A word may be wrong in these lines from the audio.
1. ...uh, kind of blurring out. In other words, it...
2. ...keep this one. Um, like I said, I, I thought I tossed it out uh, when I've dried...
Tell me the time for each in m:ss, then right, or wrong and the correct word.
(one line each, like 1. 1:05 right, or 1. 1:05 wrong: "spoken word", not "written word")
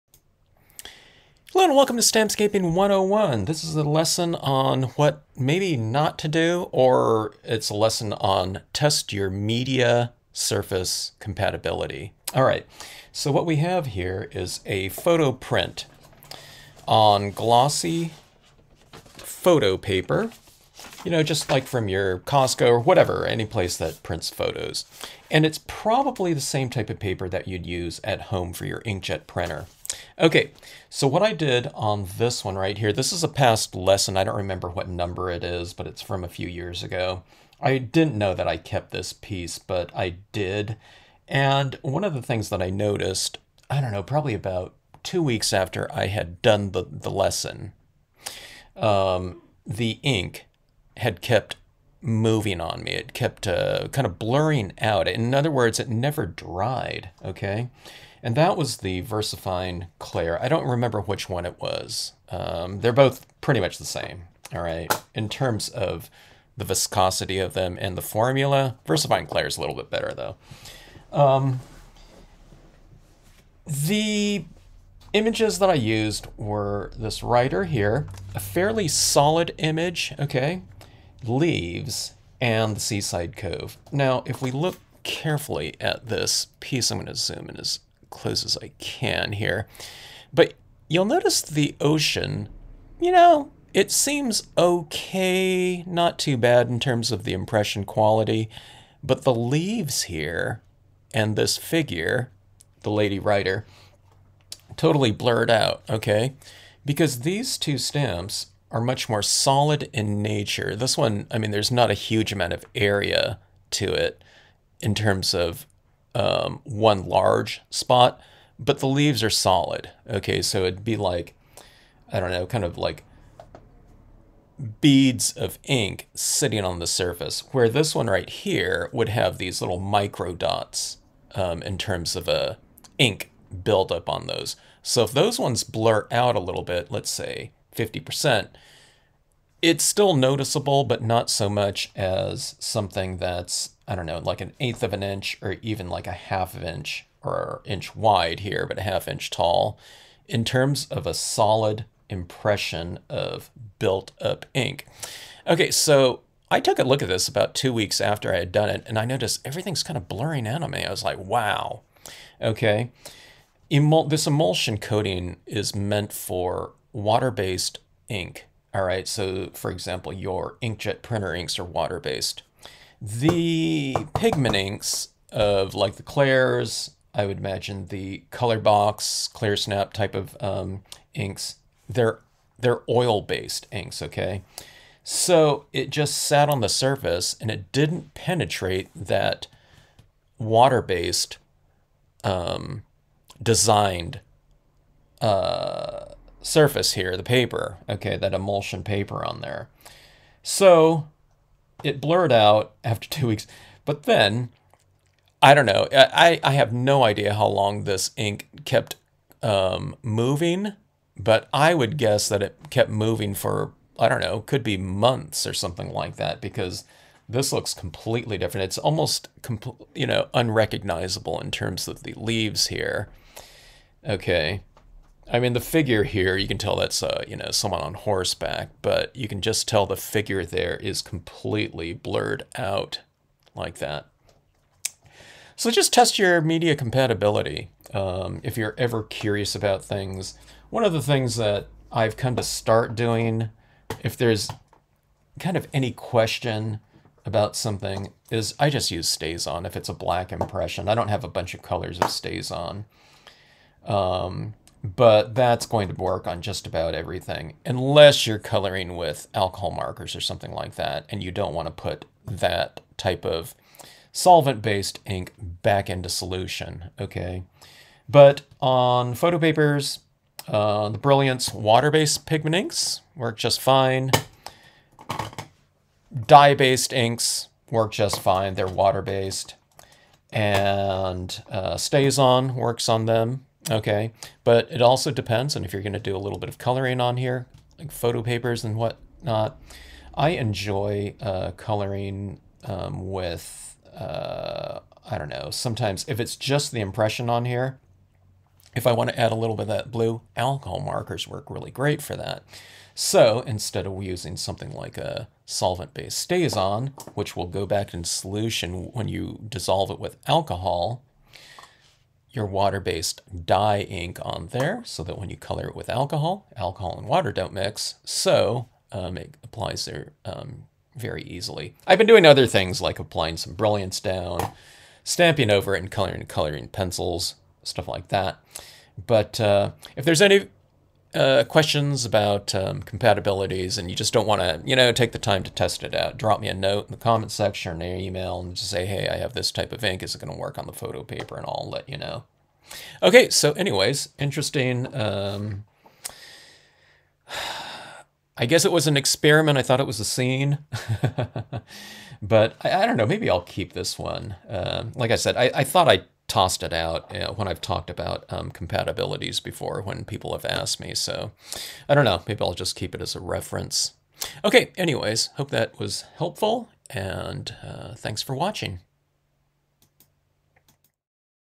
1. 0:53 right
2. 5:53 wrong: "talked", not "dried".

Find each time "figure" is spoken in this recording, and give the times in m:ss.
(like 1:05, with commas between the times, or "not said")
1:41, 3:45, 3:49.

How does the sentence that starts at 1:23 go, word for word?
Now, if we look carefully at this piece, I'm going to zoom in as close as I can here.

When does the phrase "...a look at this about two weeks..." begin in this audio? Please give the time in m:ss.
2:36.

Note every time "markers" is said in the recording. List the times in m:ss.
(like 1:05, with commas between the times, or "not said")
4:19, 5:00.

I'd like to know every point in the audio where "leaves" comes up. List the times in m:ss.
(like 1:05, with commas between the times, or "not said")
1:21, 1:39, 1:58, 3:42.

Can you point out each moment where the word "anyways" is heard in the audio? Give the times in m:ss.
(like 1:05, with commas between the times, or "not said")
5:43, 6:04.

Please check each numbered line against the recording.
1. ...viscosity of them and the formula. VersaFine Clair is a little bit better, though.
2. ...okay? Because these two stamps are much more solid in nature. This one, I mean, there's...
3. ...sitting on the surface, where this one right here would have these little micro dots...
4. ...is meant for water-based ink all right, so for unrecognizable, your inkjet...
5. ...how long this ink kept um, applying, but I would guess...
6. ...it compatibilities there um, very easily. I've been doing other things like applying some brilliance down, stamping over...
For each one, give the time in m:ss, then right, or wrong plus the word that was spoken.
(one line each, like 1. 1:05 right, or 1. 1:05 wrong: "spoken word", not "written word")
1. 1:06 right
2. 1:45 right
3. 2:06 right
4. 2:45 wrong: "example", not "unrecognizable"
5. 3:27 wrong: "moving", not "applying"
6. 5:19 wrong: "applies", not "compatibilities".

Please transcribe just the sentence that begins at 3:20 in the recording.
So it blurred out after two weeks.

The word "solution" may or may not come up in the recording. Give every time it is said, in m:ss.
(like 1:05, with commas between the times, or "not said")
4:26, 5:08.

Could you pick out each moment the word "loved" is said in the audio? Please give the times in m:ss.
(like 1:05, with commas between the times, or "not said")
not said.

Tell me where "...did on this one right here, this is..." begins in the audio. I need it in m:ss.
0:31.